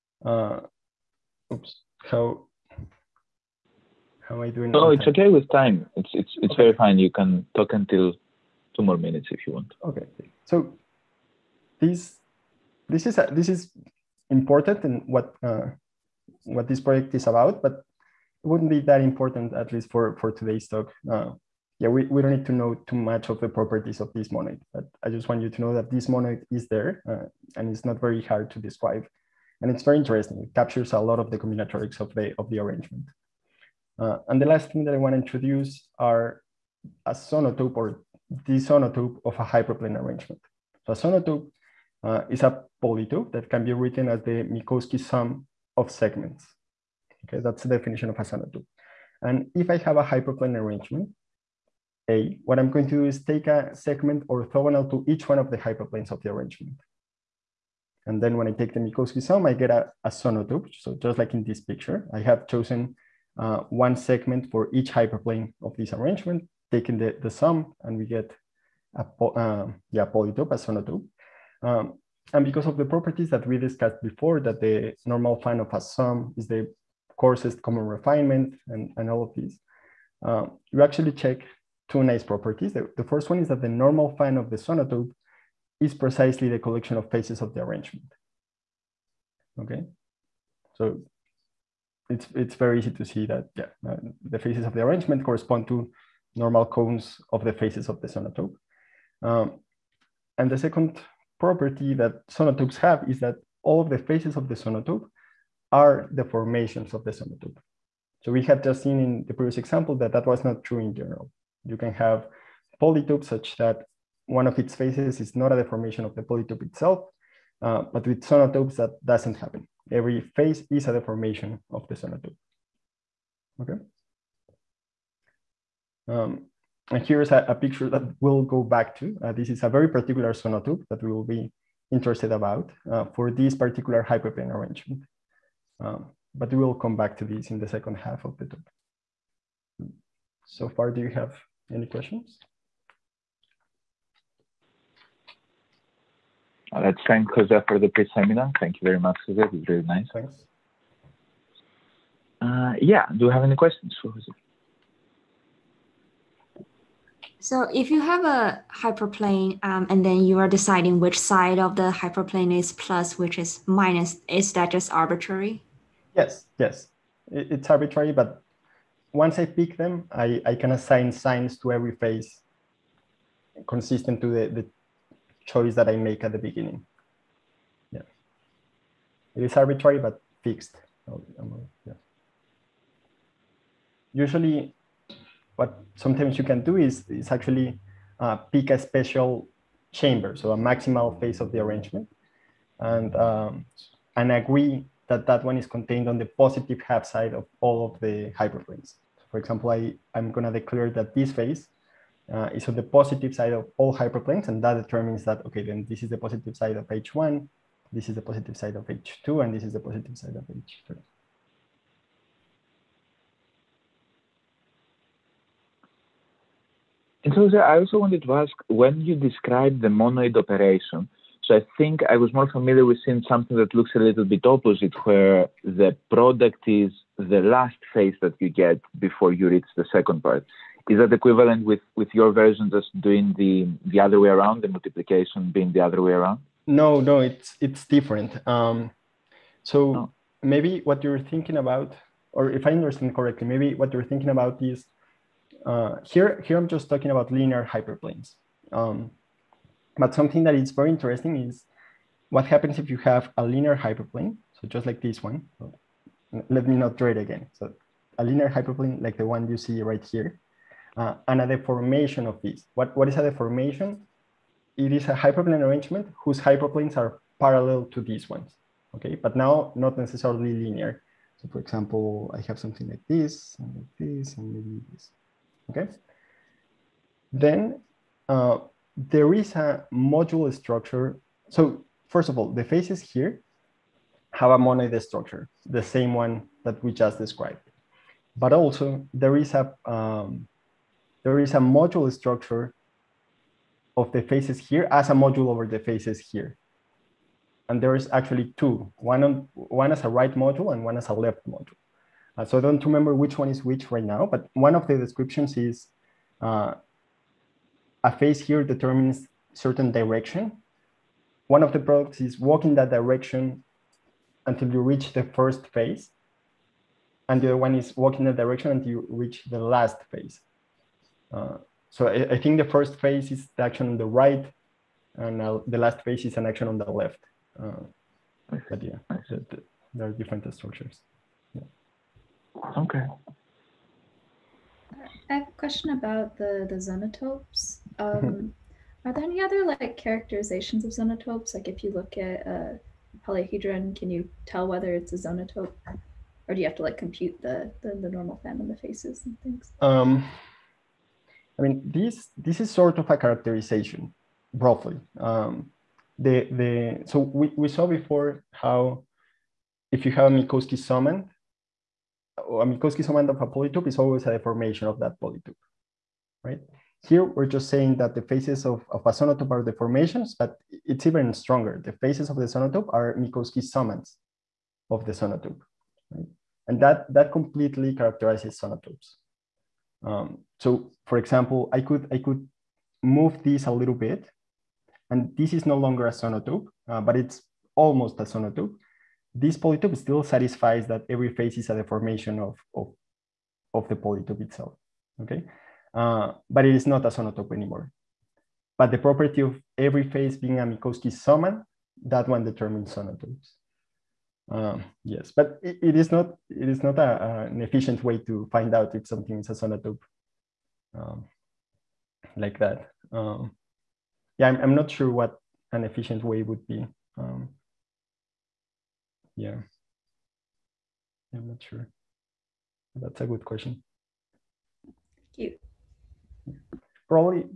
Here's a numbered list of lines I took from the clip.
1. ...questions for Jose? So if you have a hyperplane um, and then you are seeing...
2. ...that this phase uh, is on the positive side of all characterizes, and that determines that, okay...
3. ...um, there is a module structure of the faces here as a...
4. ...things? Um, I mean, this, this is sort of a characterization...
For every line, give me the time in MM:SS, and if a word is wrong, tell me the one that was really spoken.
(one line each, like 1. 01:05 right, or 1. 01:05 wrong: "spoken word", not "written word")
1. 02:33 wrong: "deciding", not "seeing"
2. 03:20 wrong: "hyperplanes", not "characterizes"
3. 04:49 right
4. 05:49 right.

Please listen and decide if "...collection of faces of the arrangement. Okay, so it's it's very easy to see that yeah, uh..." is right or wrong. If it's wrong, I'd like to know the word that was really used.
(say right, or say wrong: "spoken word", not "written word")
right.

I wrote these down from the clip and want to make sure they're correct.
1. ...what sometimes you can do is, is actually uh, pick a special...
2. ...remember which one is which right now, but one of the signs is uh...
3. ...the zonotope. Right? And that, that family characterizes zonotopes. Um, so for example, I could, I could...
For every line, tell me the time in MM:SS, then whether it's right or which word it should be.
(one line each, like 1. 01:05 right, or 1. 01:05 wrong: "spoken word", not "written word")
1. 03:05 right
2. 05:02 wrong: "descriptions", not "signs"
3. 06:15 wrong: "completely", not "family".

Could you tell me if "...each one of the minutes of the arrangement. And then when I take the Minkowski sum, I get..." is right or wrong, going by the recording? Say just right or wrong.
wrong.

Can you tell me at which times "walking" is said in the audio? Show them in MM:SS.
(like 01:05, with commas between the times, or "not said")
05:12, 05:18.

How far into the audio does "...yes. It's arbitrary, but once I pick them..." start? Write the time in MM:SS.
02:46.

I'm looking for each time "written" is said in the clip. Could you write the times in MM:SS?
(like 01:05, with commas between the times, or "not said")
00:43.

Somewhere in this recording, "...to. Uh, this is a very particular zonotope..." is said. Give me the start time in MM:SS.
02:08.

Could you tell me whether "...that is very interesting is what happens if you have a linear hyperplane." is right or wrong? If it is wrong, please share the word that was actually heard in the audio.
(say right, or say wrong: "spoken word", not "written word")
right.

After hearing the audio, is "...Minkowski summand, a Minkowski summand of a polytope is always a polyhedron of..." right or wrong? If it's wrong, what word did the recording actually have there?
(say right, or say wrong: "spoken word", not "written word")
wrong: "deformation", not "polyhedron".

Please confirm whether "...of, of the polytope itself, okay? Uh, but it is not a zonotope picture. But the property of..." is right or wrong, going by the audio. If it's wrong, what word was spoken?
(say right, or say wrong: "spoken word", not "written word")
wrong: "anymore", not "picture".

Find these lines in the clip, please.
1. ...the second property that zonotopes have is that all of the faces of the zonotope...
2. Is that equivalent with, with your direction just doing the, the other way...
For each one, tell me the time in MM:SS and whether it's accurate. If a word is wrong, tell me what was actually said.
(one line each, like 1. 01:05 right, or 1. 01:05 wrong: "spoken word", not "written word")
1. 01:40 right
2. 03:50 wrong: "version", not "direction".